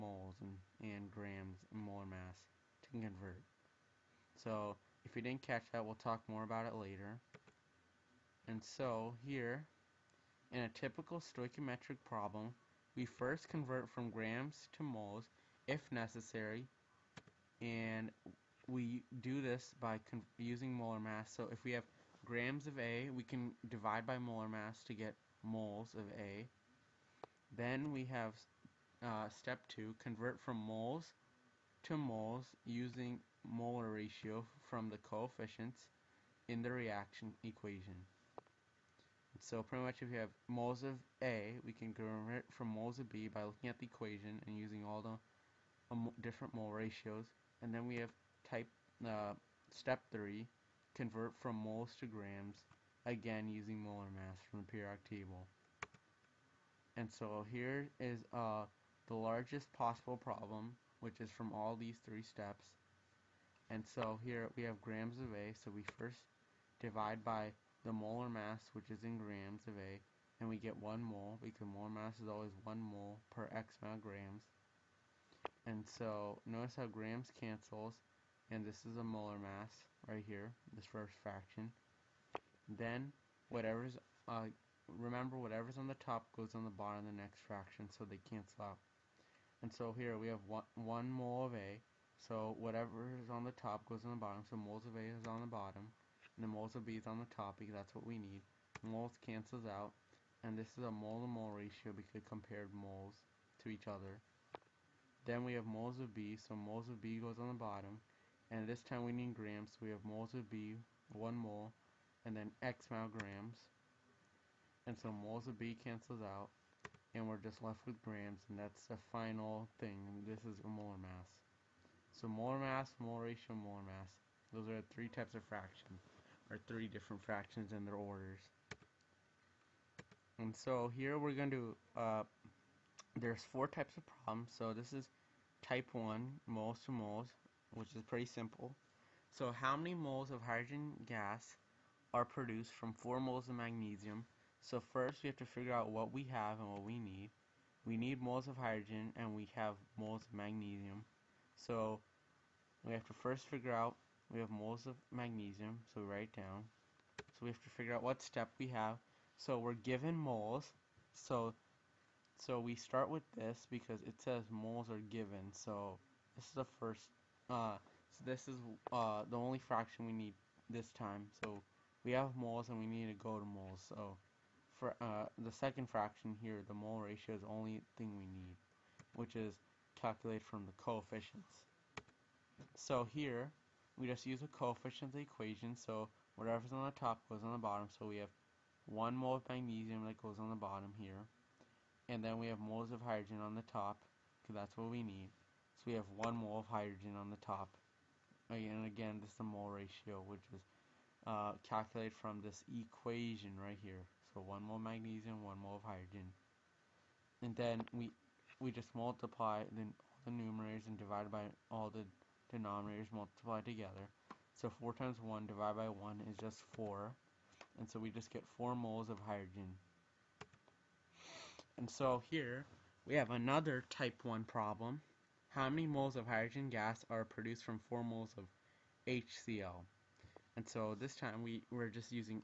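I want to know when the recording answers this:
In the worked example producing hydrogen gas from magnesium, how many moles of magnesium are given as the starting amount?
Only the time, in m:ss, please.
2:22.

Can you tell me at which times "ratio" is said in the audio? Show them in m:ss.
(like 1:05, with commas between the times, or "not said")
0:33, 0:46, 1:41, 2:03, 2:56, 3:19.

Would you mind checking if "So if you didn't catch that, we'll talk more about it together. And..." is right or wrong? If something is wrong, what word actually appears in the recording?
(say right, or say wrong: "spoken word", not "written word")
wrong: "later", not "together".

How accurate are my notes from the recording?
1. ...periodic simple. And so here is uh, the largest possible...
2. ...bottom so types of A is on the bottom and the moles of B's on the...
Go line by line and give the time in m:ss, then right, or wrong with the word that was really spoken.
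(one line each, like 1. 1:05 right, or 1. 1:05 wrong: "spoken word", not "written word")
1. 0:54 wrong: "table", not "simple"
2. 1:34 wrong: "moles", not "types".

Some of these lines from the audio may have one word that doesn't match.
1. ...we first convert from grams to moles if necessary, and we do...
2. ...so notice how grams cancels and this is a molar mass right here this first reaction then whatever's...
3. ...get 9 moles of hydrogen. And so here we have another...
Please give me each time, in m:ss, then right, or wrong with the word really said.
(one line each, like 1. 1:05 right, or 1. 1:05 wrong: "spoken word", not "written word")
1. 0:12 right
2. 1:15 wrong: "fraction", not "reaction"
3. 3:38 wrong: "4", not "9".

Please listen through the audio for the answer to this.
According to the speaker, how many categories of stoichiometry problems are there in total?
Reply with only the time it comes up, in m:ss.
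2:13.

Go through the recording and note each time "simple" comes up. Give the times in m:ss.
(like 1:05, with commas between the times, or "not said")
2:18.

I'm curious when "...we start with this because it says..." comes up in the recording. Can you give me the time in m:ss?
2:42.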